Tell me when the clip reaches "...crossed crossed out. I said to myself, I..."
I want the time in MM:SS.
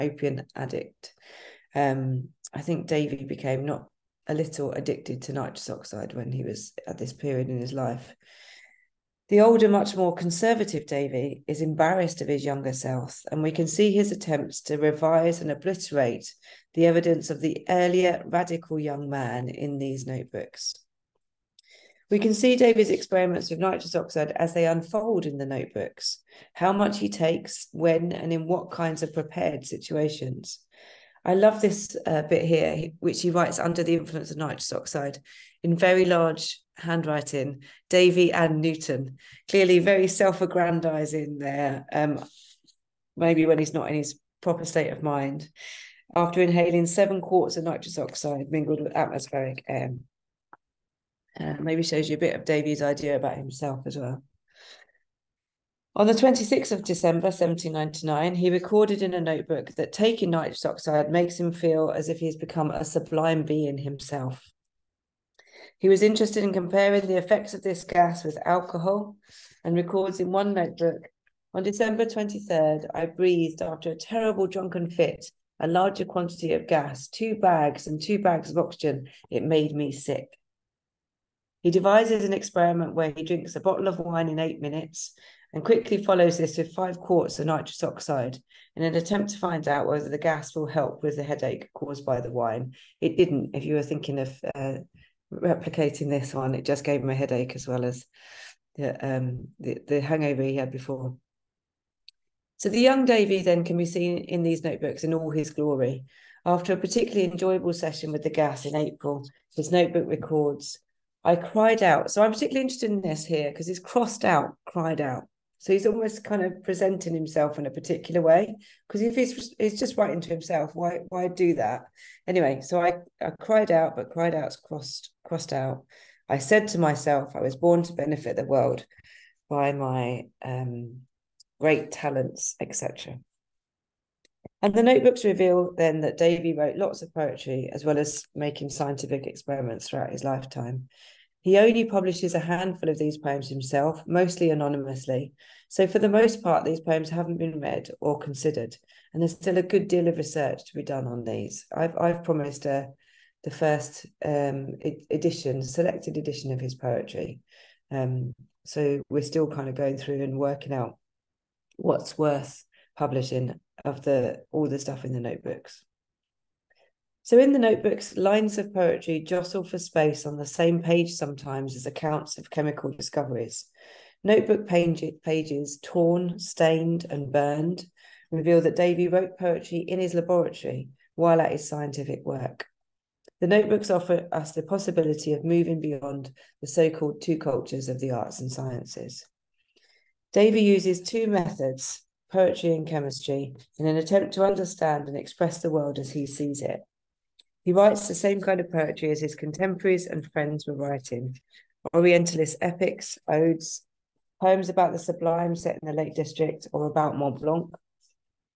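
02:04.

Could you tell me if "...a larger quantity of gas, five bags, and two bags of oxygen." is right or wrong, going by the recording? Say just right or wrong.
wrong.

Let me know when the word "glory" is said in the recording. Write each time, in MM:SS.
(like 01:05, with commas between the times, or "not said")
01:45.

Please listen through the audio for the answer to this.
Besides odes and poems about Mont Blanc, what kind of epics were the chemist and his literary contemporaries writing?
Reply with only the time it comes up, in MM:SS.
03:21.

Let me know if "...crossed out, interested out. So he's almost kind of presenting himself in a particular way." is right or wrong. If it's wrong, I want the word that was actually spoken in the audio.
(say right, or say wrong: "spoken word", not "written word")
wrong: "cried", not "interested".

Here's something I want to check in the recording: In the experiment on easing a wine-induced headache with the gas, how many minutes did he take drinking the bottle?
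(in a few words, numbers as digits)
8.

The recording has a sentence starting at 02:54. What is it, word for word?
Notebook pages, torn, stained, and burned, reveal that Davy wrote poetry in his laboratory while at his scientific work.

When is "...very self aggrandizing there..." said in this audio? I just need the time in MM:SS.
00:39.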